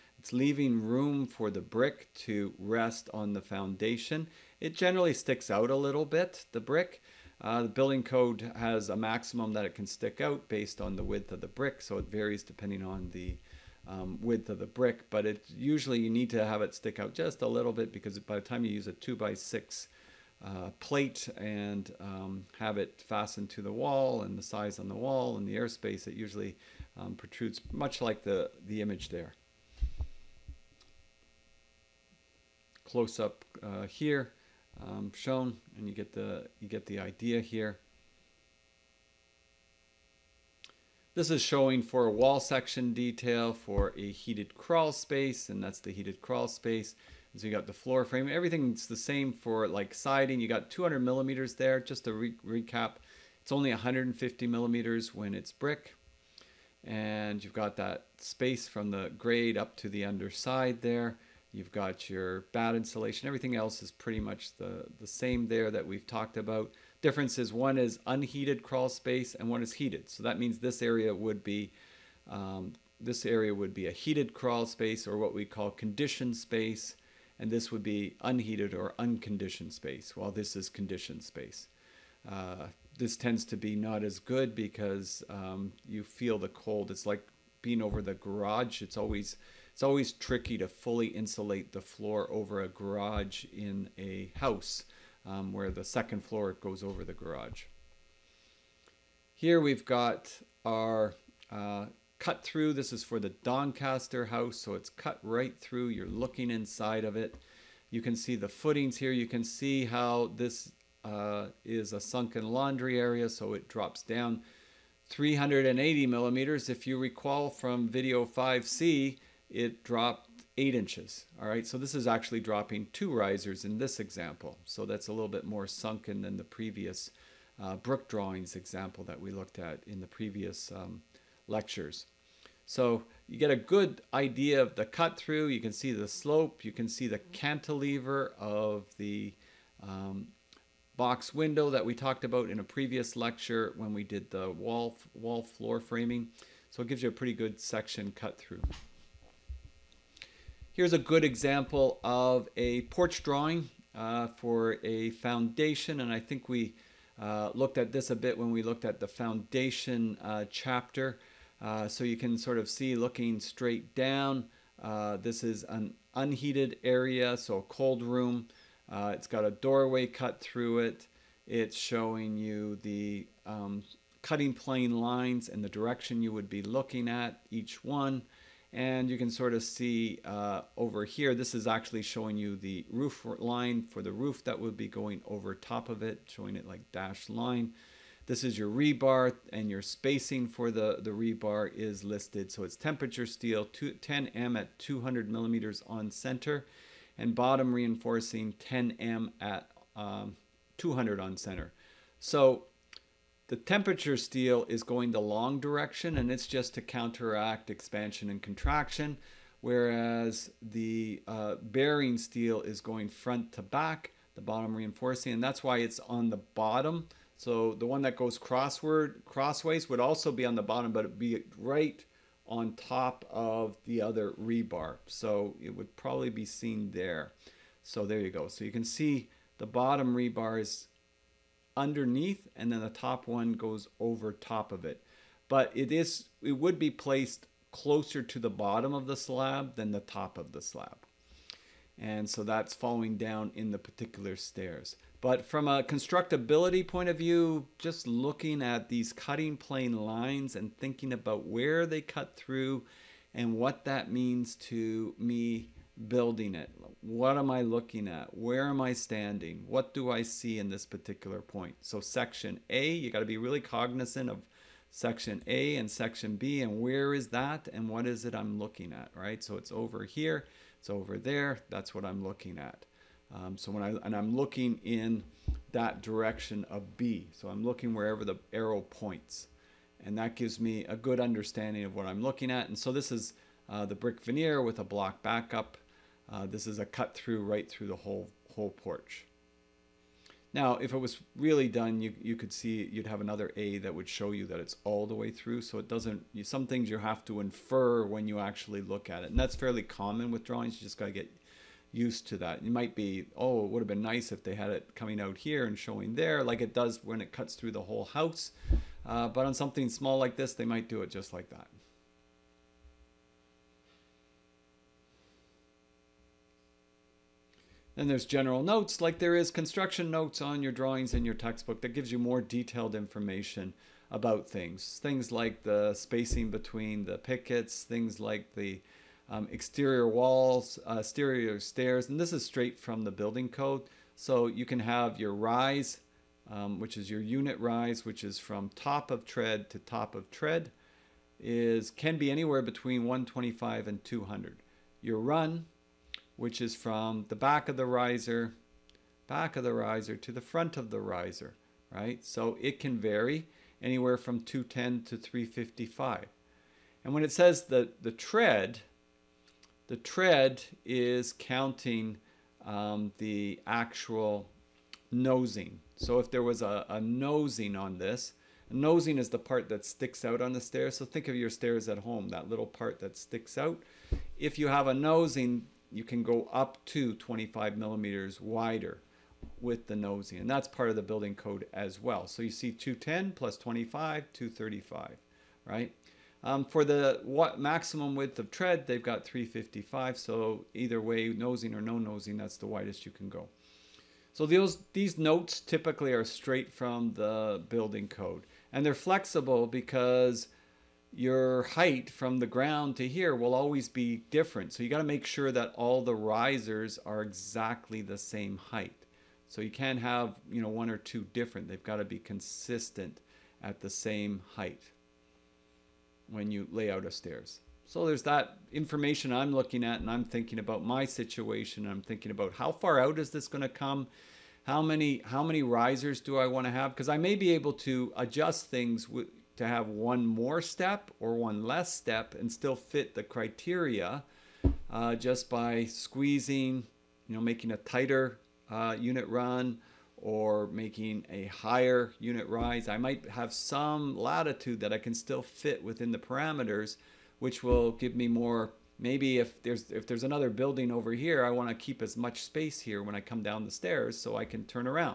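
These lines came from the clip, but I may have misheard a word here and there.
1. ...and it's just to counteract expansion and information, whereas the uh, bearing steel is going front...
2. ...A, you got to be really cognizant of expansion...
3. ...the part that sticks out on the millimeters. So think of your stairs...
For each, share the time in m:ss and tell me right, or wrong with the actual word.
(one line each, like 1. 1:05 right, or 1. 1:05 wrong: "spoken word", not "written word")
1. 3:26 wrong: "contraction", not "information"
2. 4:22 wrong: "section", not "expansion"
3. 6:09 wrong: "stairs", not "millimeters".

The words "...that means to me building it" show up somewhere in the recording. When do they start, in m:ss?
4:13.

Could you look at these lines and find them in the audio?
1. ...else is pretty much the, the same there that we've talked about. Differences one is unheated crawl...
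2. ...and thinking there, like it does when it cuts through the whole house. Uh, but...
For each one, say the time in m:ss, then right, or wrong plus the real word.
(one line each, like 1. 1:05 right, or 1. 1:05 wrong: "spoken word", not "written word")
1. 1:03 right
2. 5:05 wrong: "showing", not "thinking".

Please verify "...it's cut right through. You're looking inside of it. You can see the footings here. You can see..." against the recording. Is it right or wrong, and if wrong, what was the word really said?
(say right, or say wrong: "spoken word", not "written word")
right.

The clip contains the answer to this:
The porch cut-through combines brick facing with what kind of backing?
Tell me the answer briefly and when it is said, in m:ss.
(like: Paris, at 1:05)
block backup, at 4:44.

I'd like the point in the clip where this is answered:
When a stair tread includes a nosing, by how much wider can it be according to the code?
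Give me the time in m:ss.
6:17.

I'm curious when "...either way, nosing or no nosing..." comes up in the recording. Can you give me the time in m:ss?
6:30.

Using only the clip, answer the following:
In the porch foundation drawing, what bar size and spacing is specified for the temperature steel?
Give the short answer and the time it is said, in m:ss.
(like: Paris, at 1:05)
10M at 200 millimeters, at 3:13.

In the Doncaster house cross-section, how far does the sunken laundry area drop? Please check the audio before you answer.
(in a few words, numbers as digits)
380 millimeters.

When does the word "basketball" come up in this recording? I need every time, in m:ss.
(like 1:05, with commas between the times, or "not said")
not said.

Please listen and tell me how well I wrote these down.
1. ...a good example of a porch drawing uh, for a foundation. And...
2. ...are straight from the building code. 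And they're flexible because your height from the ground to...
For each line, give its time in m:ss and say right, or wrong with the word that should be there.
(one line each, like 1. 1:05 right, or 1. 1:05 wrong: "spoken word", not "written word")
1. 2:30 right
2. 6:36 right.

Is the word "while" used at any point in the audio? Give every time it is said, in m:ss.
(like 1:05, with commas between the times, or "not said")
1:20.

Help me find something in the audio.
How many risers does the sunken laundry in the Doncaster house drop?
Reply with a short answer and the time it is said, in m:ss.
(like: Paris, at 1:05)
2, at 2:02.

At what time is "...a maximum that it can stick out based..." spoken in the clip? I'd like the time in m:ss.
0:08.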